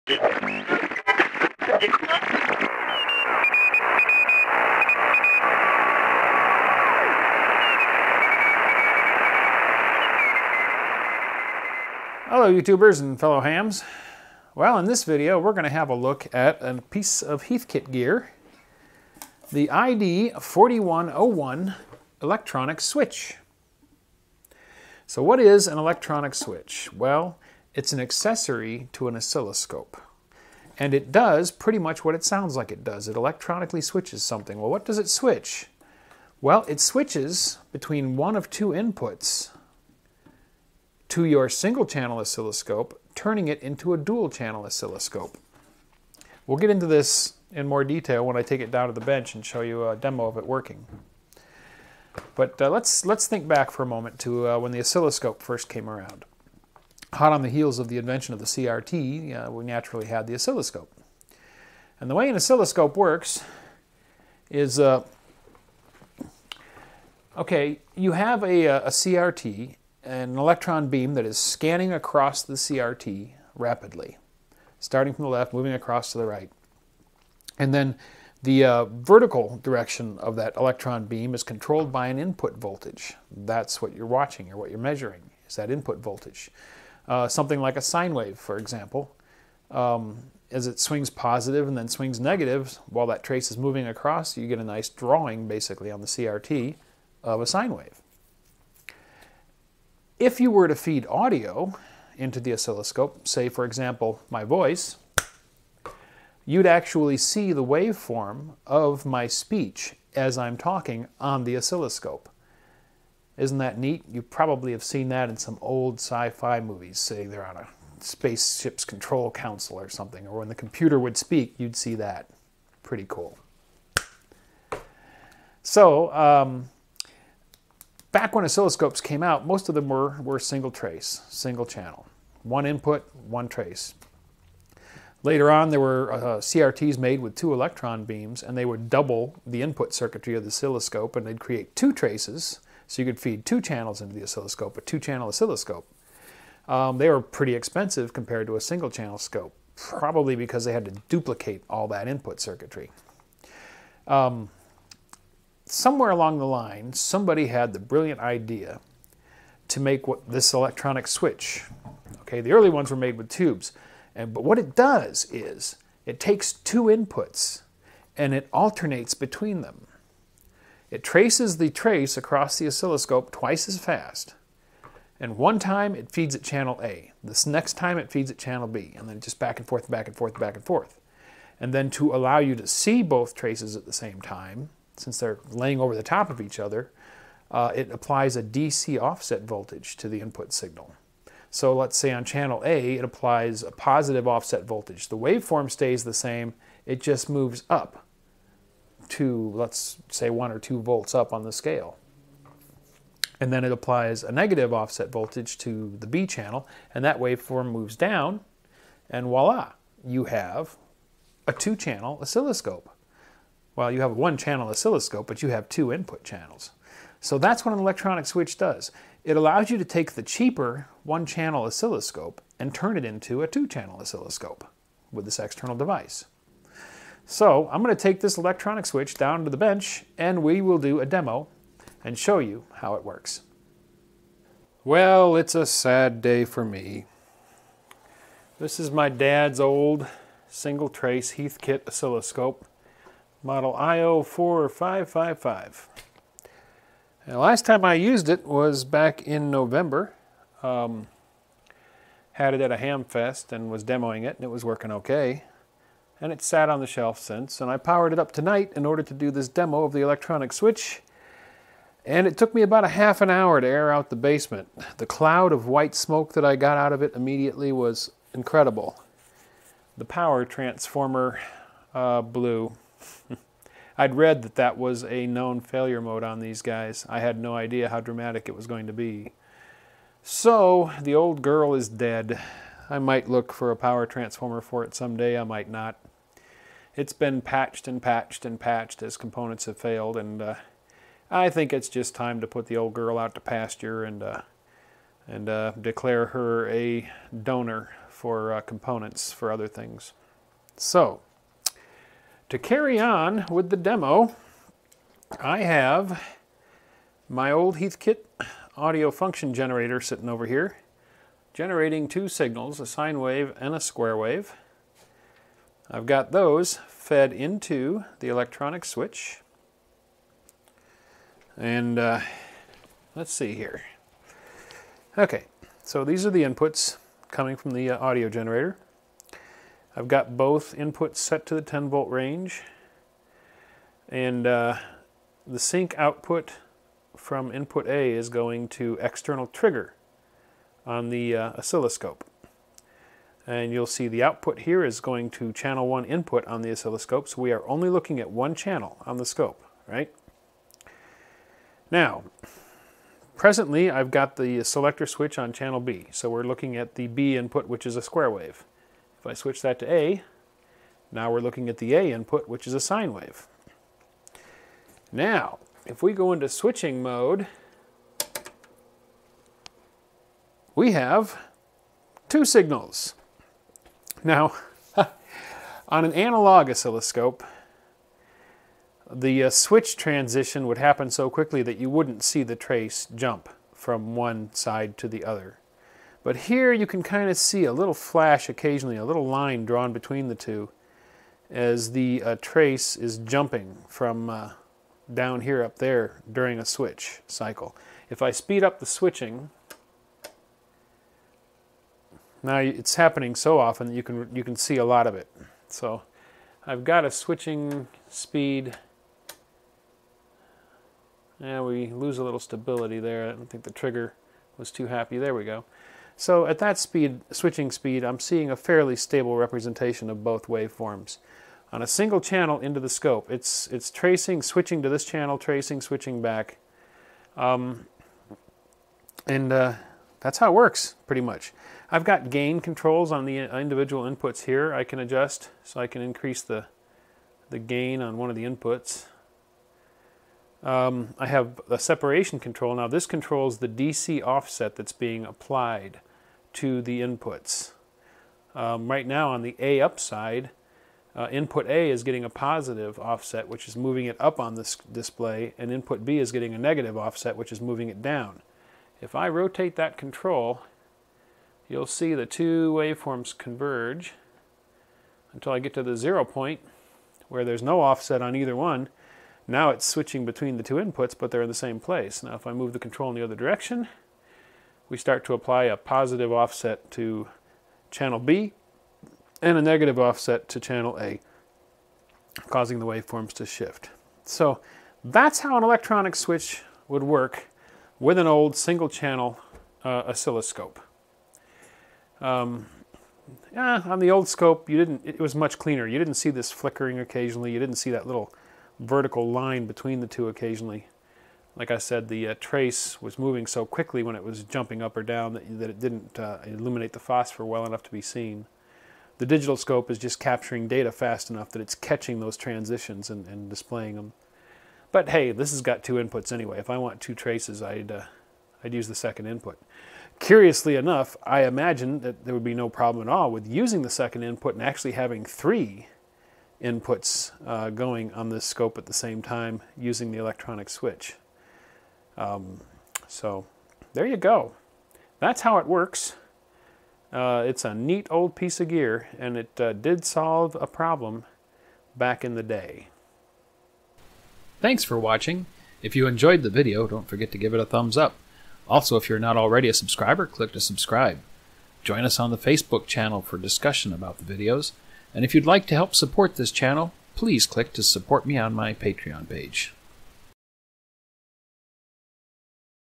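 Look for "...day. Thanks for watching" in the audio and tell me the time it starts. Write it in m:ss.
9:02.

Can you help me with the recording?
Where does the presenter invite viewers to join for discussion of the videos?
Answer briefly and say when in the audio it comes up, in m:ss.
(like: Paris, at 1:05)
Facebook, at 9:12.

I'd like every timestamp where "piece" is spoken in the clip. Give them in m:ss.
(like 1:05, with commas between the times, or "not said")
0:16, 8:58.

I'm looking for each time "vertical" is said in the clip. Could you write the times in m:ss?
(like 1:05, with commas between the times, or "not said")
1:18, 8:18.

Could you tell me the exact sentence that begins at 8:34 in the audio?
But hey, this has got two inputs anyway.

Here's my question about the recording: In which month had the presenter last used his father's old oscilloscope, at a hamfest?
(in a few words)
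November.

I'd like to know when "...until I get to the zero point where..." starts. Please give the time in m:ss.
7:45.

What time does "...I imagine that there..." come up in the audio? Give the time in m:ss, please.
8:41.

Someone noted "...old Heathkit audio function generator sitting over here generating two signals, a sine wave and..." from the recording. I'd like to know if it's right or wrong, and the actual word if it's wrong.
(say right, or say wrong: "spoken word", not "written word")
right.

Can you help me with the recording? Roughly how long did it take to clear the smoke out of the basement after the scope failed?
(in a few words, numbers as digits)
half an hour.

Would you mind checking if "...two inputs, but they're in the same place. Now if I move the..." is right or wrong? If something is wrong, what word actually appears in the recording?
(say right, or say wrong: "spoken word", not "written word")
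right.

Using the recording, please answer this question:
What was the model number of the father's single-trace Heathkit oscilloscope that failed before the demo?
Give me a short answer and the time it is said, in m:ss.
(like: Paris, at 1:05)
IO4555, at 4:03.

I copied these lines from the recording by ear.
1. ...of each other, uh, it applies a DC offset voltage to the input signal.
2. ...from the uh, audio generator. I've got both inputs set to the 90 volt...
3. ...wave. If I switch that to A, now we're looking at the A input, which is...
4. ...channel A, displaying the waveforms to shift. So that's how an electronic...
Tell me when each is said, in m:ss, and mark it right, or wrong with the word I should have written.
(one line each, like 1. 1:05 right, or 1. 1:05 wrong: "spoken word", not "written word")
1. 3:06 right
2. 5:27 wrong: "10", not "90"
3. 5:58 right
4. 8:00 wrong: "causing", not "displaying".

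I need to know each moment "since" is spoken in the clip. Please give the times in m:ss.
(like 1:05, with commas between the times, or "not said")
3:04, 4:17.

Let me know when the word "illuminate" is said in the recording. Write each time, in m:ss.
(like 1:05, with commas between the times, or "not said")
8:26.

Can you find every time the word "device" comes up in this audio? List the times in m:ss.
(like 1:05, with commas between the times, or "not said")
3:45.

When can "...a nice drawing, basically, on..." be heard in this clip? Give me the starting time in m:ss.
1:34.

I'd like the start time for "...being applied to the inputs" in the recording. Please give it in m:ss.
7:24.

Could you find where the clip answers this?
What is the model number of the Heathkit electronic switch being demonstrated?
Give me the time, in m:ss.
0:19.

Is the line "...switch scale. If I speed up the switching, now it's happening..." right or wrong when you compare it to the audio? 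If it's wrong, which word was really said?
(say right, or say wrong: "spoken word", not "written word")
wrong: "cycle", not "scale".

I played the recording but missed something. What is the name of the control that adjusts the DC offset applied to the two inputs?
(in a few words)
separation control.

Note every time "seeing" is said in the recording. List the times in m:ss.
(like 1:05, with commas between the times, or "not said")
6:58.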